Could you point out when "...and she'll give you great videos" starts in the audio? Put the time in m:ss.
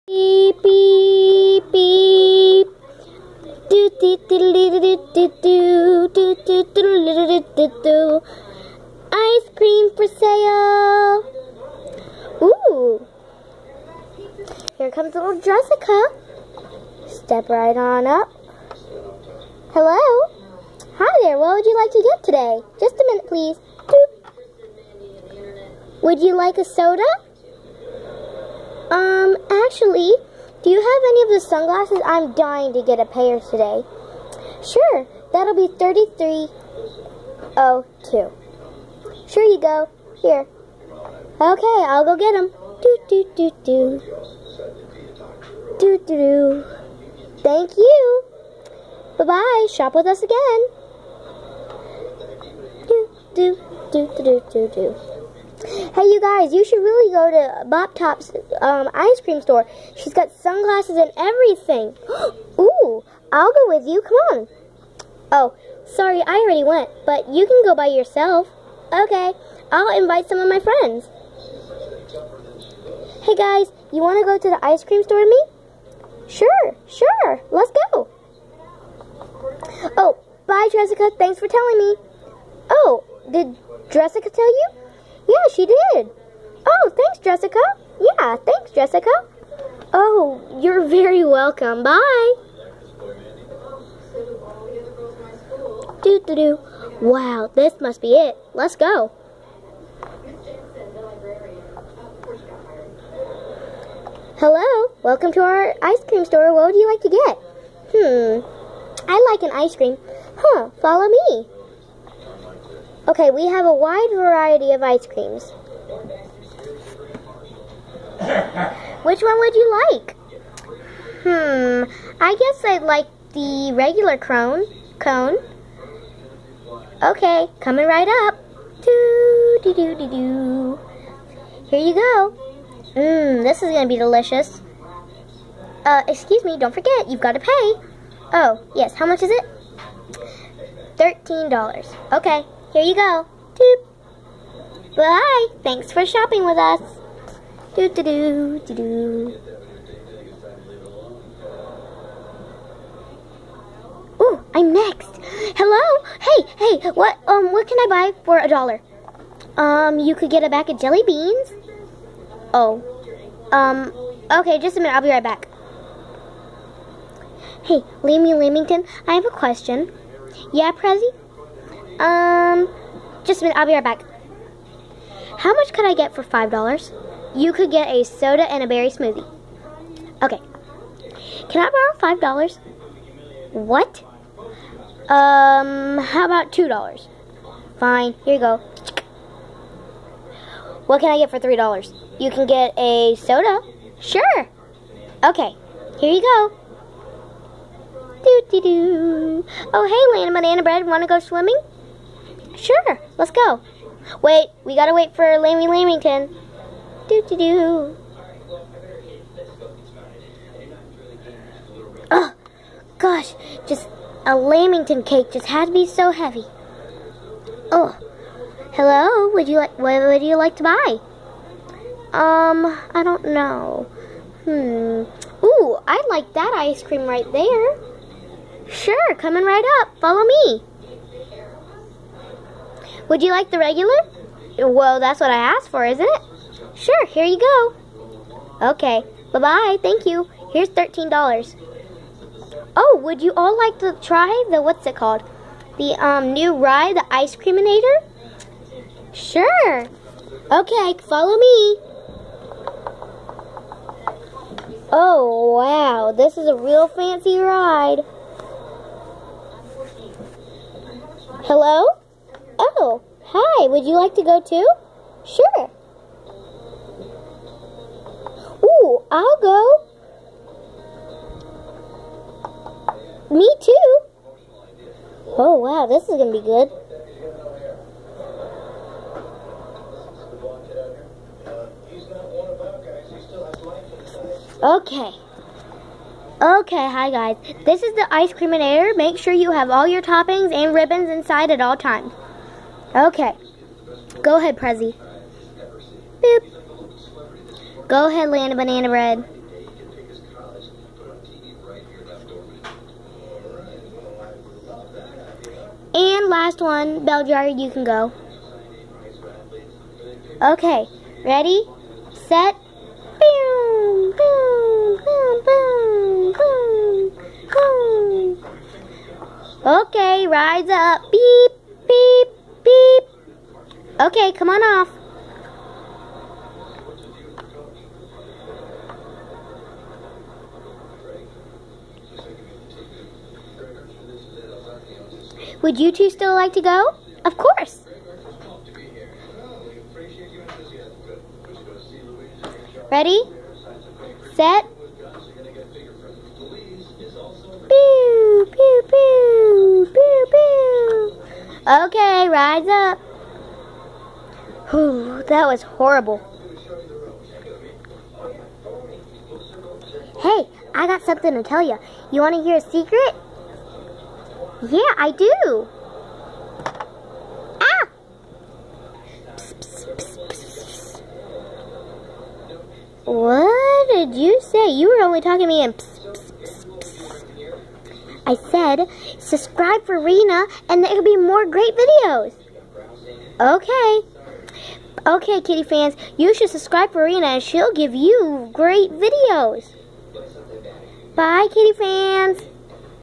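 6:27.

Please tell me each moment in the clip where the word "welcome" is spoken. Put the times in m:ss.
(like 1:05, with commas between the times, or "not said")
1:31, 1:45.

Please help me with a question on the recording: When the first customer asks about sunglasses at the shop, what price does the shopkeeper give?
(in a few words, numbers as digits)
3302.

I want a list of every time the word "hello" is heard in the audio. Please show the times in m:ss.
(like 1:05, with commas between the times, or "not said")
0:19, 1:44, 2:35, 3:38, 4:21.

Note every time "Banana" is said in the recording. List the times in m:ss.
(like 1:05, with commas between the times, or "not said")
3:20, 4:58.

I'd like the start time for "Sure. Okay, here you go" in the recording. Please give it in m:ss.
3:13.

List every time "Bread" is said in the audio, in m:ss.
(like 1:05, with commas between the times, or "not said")
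3:20, 4:58.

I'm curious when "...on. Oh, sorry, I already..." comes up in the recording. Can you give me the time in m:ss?
1:04.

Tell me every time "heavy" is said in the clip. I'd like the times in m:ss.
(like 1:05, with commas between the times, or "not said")
3:36.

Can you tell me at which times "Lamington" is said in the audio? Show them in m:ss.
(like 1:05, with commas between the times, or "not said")
2:48, 3:25, 3:34.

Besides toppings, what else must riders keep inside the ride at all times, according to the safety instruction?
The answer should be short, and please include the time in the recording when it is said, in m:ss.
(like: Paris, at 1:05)
Ribbons, at 4:50.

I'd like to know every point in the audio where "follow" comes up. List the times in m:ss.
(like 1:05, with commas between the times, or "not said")
1:50, 3:50, 4:11.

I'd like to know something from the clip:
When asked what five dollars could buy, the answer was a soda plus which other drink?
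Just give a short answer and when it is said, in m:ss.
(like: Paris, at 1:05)
Berry smoothie, at 2:58.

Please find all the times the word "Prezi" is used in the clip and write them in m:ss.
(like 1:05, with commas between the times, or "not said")
2:50, 4:54.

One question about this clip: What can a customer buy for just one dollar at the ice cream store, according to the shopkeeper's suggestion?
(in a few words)
A bag of jelly beans.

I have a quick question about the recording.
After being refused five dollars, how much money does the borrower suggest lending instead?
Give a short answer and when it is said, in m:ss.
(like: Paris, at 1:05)
$2, at 3:06.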